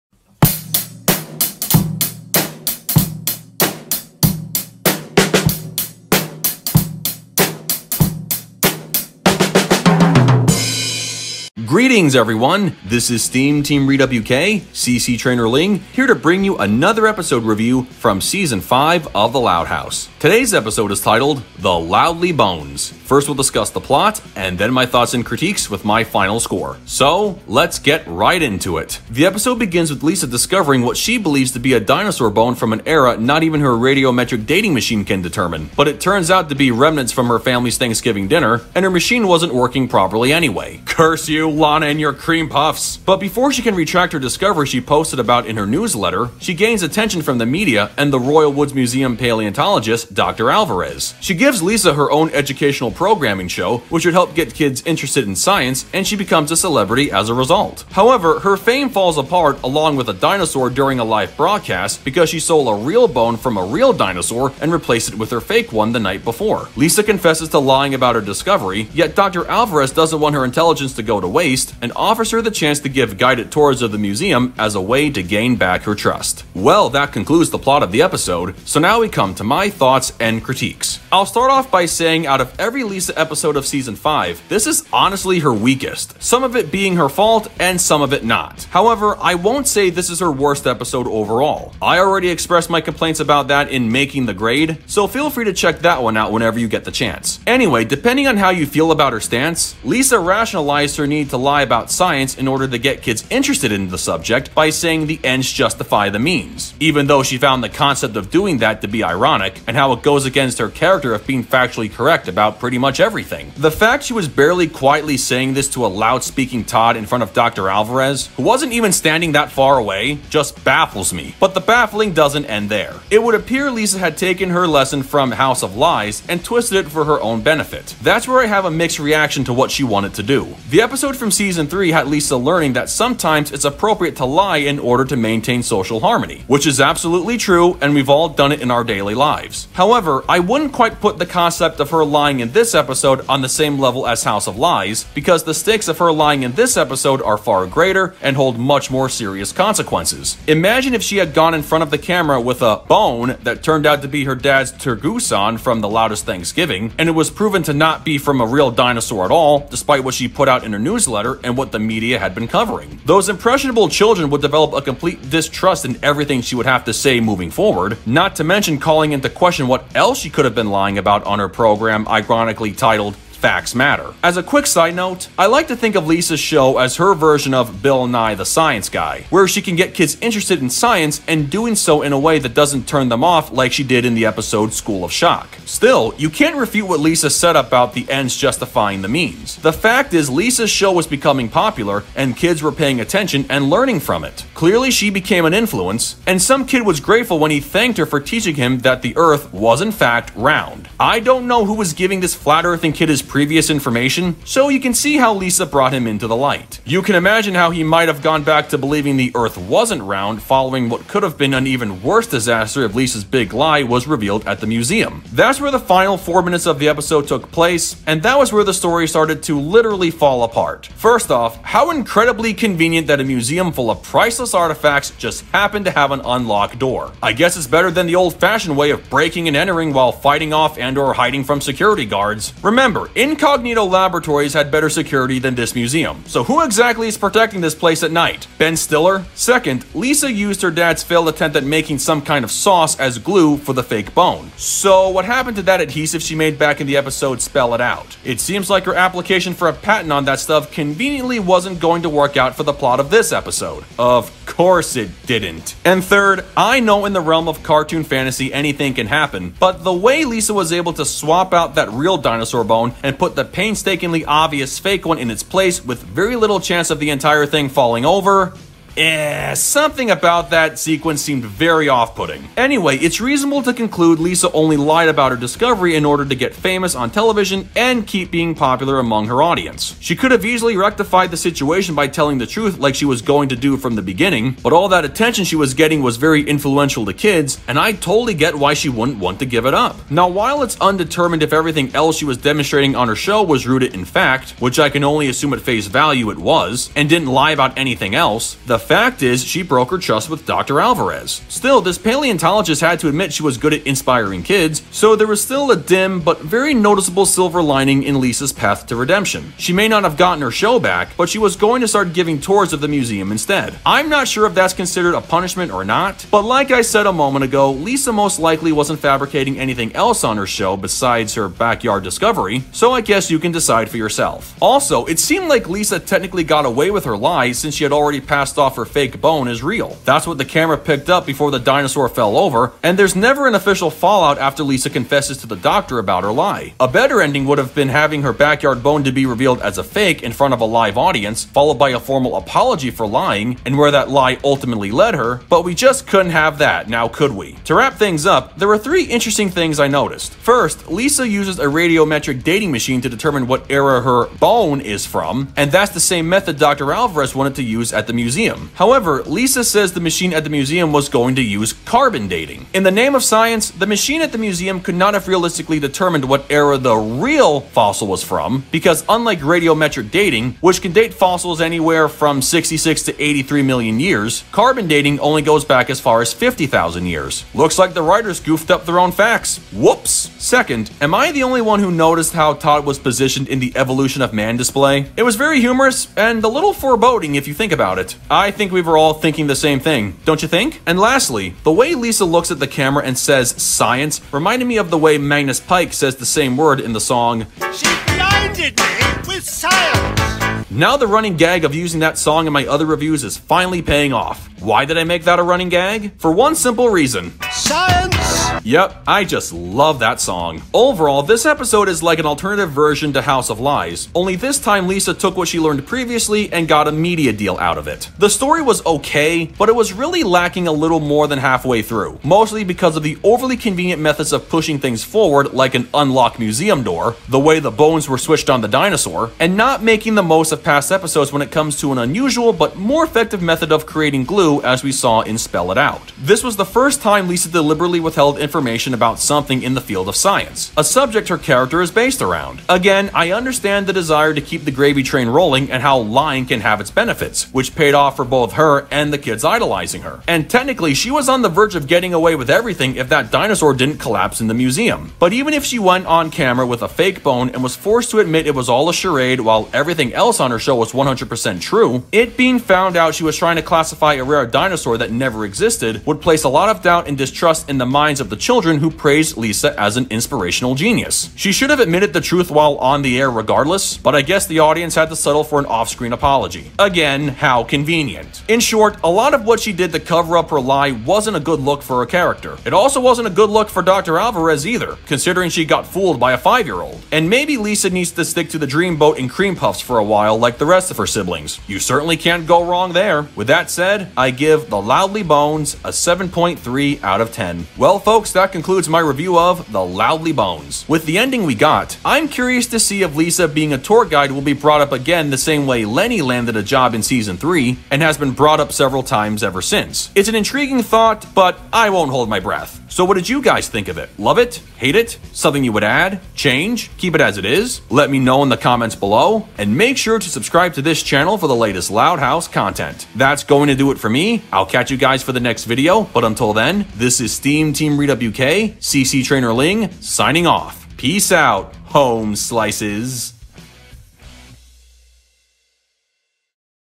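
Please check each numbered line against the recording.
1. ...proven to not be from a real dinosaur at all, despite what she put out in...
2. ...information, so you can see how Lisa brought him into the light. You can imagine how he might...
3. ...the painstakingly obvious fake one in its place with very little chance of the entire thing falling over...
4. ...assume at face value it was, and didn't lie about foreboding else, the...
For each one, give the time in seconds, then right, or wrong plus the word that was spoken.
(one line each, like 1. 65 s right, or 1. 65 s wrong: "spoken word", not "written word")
1. 157 s right
2. 203 s right
3. 263 s right
4. 295 s wrong: "anything", not "foreboding".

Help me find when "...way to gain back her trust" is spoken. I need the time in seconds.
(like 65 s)
74 s.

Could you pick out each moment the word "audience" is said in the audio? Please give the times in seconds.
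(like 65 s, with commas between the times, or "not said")
279 s, 340 s, 474 s.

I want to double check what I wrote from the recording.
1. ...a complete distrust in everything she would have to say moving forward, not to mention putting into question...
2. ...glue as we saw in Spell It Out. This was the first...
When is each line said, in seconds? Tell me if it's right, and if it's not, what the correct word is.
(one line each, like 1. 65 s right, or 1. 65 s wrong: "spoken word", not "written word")
1. 164 s wrong: "calling", not "putting"
2. 434 s right.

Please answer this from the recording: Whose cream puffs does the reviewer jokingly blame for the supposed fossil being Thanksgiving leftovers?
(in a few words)
Lana.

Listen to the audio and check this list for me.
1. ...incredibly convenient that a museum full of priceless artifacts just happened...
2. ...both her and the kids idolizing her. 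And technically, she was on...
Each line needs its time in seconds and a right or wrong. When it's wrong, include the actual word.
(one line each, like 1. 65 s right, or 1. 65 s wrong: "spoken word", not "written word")
1. 221 s right
2. 448 s right.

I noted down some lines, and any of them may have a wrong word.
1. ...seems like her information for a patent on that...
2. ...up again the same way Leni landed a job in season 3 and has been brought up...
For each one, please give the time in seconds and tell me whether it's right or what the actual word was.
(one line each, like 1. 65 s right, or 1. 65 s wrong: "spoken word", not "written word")
1. 248 s wrong: "application", not "information"
2. 504 s right.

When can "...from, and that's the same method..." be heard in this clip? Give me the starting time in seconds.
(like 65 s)
355 s.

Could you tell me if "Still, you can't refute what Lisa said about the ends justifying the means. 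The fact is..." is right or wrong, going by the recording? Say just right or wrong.
right.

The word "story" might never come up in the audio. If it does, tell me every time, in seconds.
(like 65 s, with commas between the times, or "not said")
218 s, 418 s.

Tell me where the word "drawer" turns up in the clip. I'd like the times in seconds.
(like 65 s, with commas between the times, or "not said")
not said.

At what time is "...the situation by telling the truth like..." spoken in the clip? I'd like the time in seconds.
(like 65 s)
281 s.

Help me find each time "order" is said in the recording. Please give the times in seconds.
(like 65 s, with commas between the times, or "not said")
102 s, 134 s, 276 s.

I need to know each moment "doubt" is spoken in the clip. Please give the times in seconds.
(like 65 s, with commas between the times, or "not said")
466 s.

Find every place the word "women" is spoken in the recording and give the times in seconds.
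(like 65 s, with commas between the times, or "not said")
not said.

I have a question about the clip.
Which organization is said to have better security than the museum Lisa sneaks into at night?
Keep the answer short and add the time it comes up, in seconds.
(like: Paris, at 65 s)
Incognito Laboratories, at 233 s.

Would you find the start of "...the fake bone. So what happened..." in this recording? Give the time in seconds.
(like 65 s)
243 s.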